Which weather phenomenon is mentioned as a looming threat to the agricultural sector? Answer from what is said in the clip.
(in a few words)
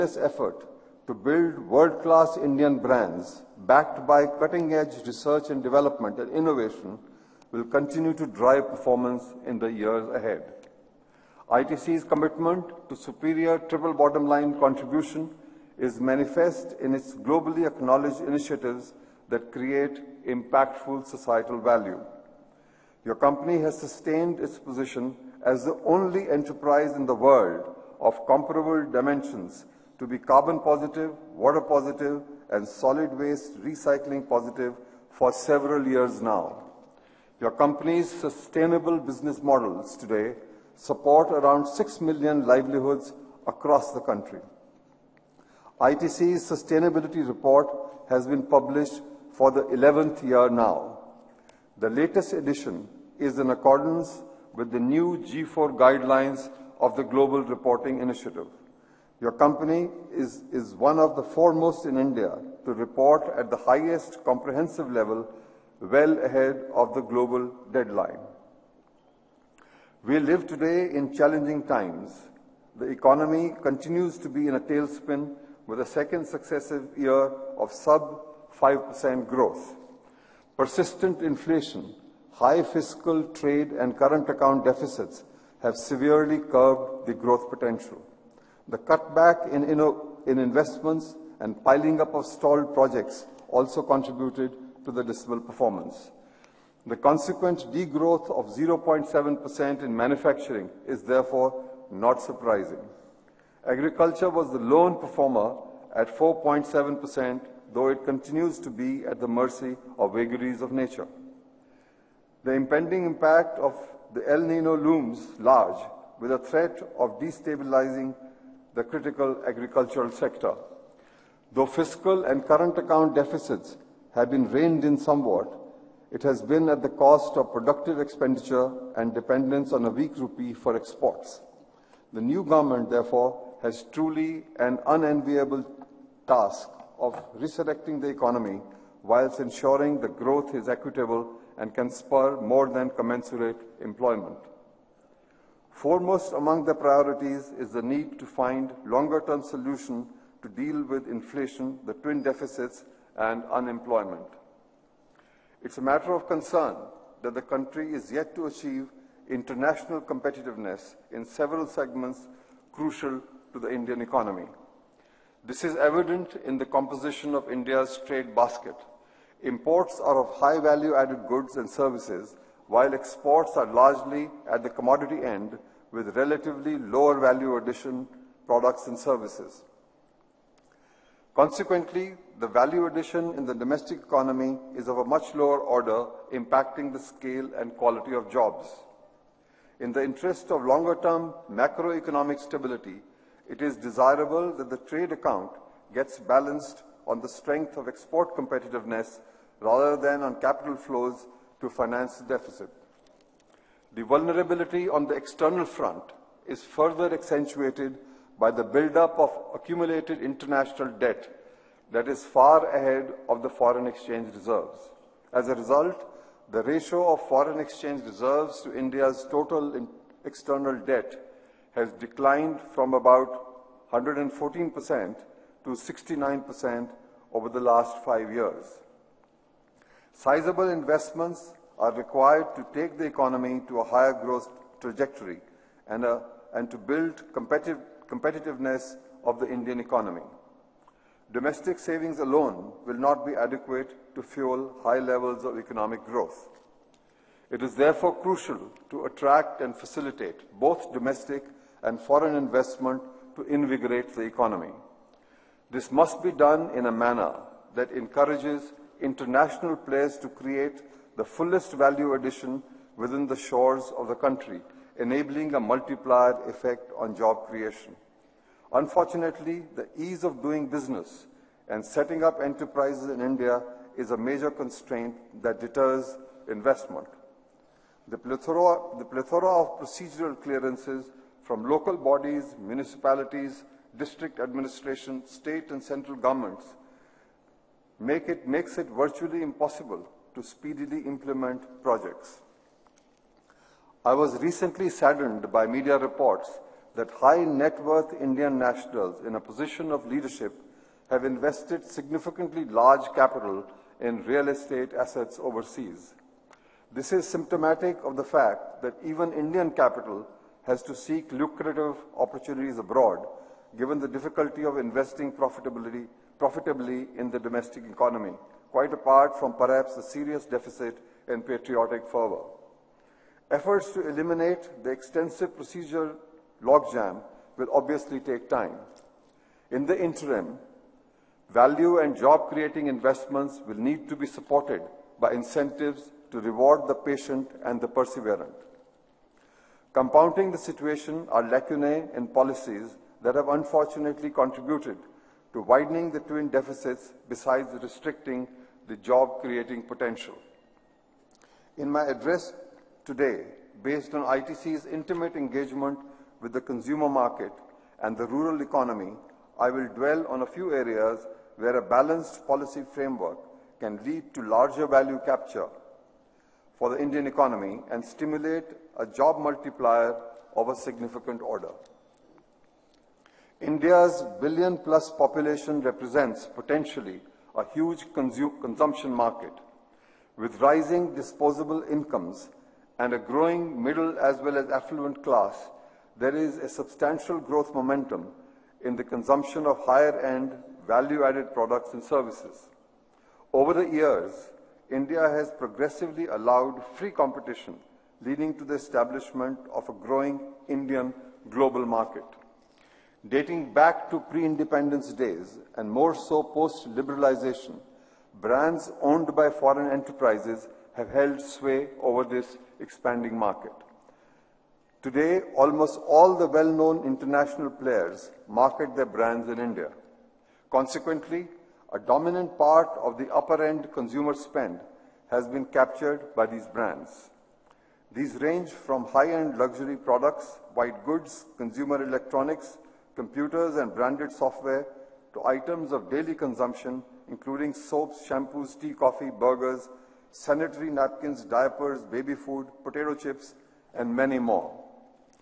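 El Nino.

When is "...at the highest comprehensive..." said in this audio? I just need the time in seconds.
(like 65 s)
63 s.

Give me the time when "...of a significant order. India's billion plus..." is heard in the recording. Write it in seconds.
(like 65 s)
370 s.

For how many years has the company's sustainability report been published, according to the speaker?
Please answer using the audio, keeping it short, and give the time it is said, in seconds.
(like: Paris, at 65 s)
11th year, at 49 s.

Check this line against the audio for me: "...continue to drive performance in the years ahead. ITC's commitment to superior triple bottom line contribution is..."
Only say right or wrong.
right.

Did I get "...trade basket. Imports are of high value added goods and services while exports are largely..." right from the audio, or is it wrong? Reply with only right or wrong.
right.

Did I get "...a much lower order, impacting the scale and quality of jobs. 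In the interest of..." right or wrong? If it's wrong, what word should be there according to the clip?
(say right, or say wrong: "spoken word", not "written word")
right.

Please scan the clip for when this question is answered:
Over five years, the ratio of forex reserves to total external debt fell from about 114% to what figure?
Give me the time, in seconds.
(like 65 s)
225 s.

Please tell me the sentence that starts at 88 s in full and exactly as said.
The cutback in, in investments and piling up of stalled projects also contributed to the dismal performance.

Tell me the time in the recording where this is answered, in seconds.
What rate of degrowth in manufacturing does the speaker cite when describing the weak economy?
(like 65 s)
98 s.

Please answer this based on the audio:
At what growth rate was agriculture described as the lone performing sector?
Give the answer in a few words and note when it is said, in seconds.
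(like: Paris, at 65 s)
4.7%, at 106 s.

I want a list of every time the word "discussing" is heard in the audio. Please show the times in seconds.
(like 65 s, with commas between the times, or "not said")
not said.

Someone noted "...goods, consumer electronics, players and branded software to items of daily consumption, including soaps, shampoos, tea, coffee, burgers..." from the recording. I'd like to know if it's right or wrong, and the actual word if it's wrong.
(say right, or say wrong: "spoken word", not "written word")
wrong: "computers", not "players".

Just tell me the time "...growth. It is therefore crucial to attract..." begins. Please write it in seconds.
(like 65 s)
246 s.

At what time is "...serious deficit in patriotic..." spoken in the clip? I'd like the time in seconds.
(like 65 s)
320 s.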